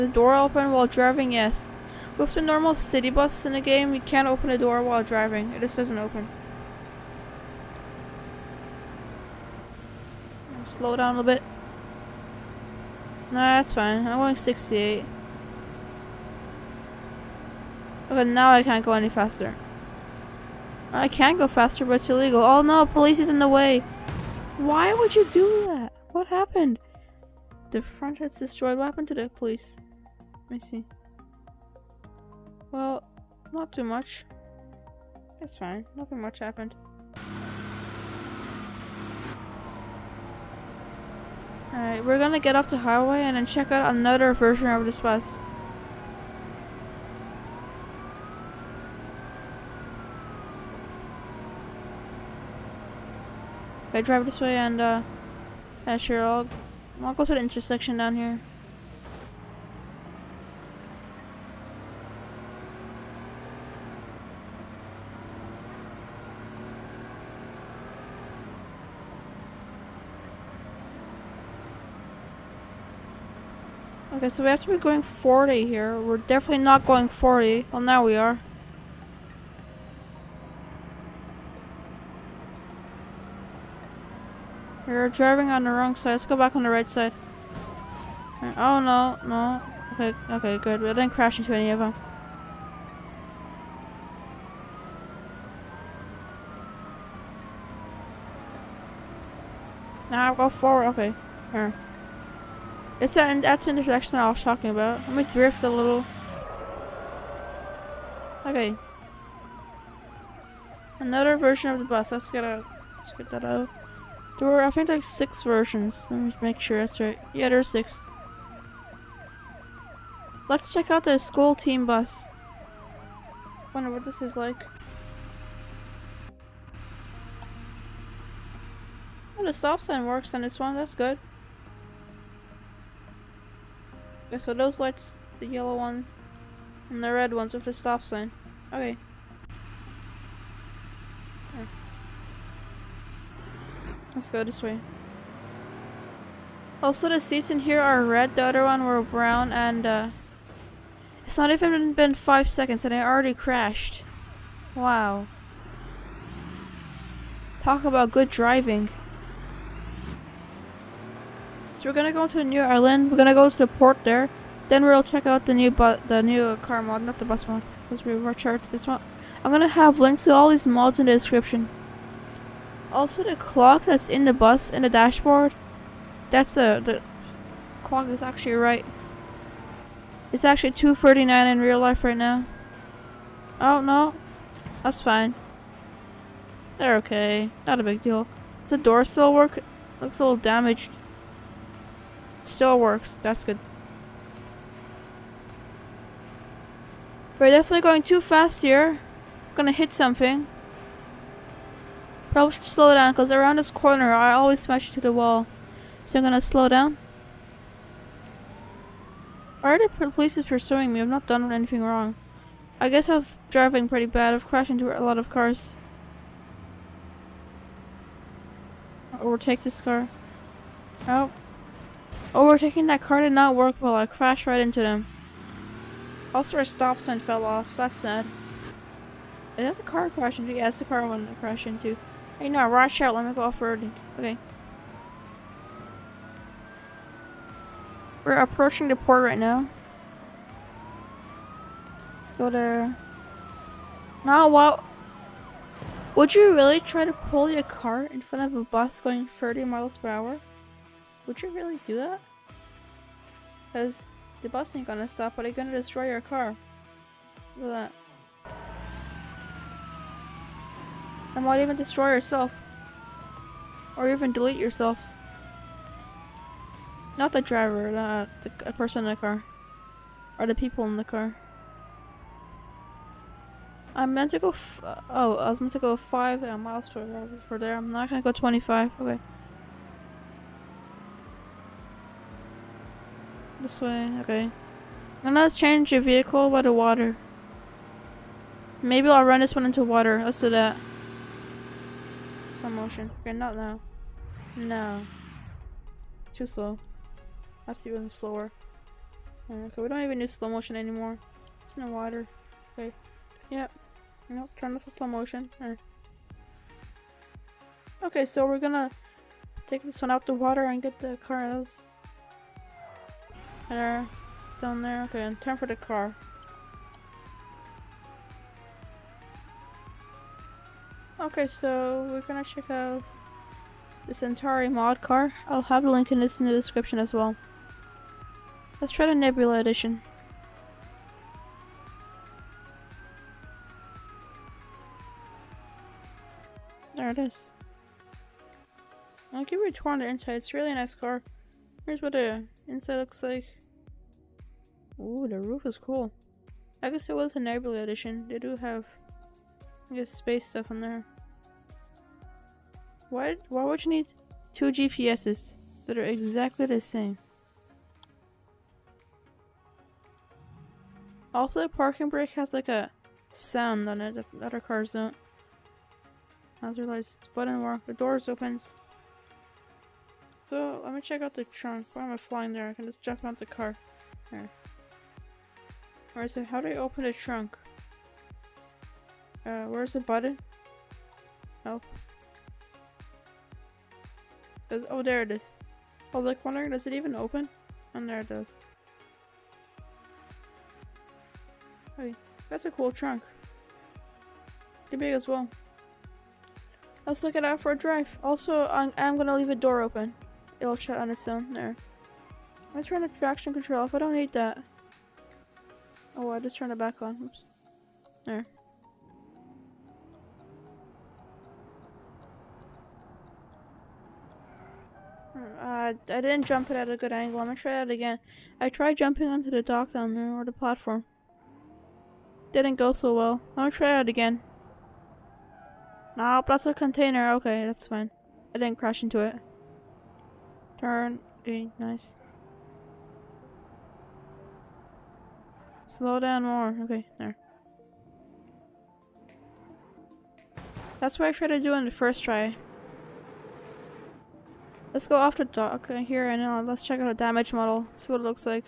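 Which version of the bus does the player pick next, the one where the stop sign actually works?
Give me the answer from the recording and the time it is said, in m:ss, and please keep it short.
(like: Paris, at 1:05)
School team bus, at 2:01.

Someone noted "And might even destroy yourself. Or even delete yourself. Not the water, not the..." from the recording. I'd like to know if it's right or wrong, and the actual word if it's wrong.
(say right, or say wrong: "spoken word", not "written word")
wrong: "driver", not "water".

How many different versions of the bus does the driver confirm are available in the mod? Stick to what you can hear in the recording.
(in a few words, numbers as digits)
6.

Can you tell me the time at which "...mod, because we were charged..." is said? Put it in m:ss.
2:47.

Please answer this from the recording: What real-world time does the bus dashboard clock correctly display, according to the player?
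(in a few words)
2:39.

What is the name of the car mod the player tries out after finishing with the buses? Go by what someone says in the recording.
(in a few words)
Centauri.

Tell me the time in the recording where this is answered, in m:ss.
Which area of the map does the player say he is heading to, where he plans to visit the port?
2:42.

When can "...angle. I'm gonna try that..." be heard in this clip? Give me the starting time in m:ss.
6:57.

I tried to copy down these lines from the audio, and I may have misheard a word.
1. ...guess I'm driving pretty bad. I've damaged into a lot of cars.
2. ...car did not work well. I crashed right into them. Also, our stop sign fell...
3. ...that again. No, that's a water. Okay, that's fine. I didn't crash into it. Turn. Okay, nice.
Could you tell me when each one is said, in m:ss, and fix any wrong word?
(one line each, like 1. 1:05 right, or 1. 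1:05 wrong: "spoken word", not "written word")
1. 3:32 wrong: "crashed", not "damaged"
2. 3:43 right
3. 7:03 wrong: "container", not "water".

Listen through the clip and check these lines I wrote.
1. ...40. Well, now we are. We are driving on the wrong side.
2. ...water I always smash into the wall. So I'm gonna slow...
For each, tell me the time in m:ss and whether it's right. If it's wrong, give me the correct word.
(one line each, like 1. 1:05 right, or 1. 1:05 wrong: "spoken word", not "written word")
1. 1:17 right
2. 3:23 wrong: "corner", not "water".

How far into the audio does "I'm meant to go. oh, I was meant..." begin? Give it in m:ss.
4:33.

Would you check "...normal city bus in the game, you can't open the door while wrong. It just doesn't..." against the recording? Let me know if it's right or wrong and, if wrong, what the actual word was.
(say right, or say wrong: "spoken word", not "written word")
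wrong: "driving", not "wrong".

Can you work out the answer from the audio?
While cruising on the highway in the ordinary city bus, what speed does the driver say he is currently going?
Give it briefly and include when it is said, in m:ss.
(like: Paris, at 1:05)
68, at 0:14.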